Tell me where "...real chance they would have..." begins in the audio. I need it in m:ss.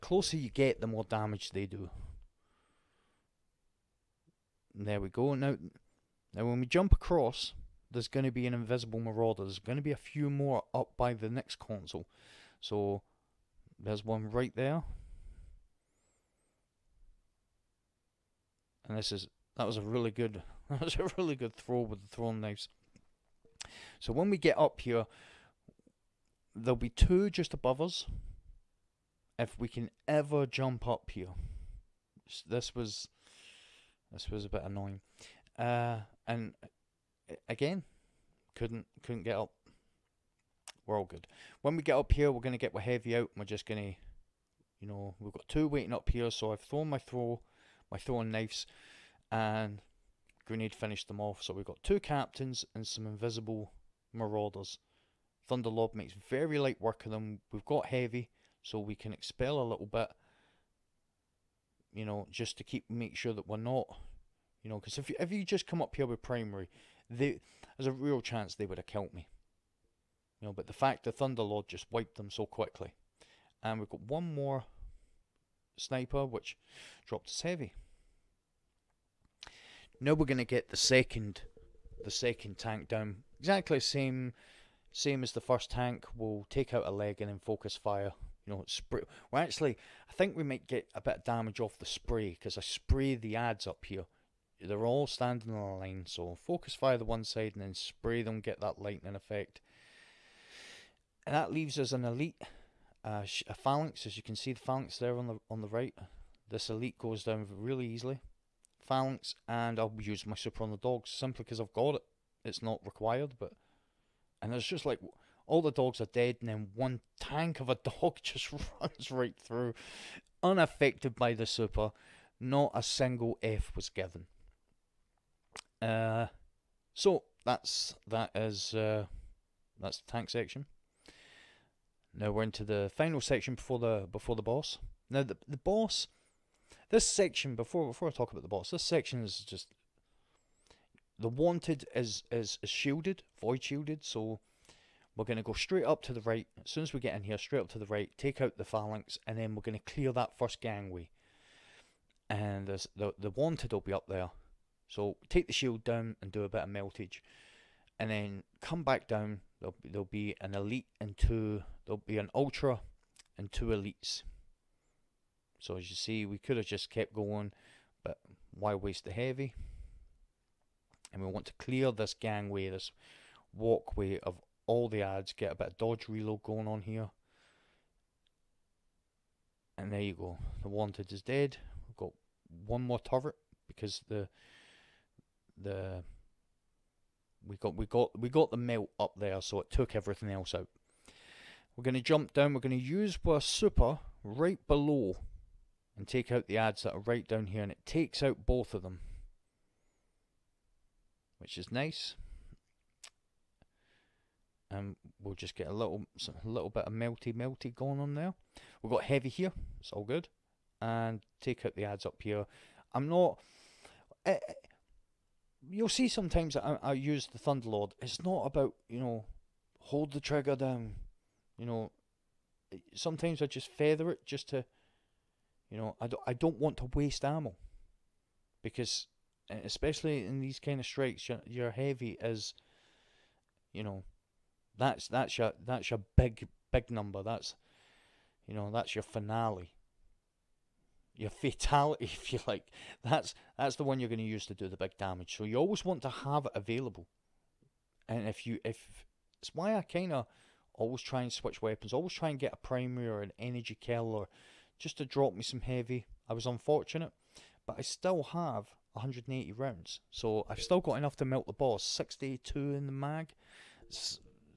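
1:07.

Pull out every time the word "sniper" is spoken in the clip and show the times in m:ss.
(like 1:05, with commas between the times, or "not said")
1:15.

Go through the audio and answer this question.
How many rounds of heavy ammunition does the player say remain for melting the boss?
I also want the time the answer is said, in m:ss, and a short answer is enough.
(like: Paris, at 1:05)
180, at 4:18.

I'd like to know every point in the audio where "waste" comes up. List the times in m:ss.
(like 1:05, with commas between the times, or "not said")
2:48, 3:46.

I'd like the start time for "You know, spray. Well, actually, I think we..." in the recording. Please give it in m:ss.
1:28.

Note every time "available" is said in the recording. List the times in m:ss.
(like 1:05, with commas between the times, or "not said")
4:06.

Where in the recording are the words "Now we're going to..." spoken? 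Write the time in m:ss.
1:20.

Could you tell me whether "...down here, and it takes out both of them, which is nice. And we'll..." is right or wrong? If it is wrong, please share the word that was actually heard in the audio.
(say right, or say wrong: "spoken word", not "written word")
right.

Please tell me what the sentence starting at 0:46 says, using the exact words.
So I've thrown my throw my throwing knives, and Grenade finished them off.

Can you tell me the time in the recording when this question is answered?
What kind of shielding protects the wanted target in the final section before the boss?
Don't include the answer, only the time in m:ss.
2:23.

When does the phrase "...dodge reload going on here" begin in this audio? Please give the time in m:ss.
2:55.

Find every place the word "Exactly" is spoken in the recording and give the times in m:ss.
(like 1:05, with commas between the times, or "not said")
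1:23.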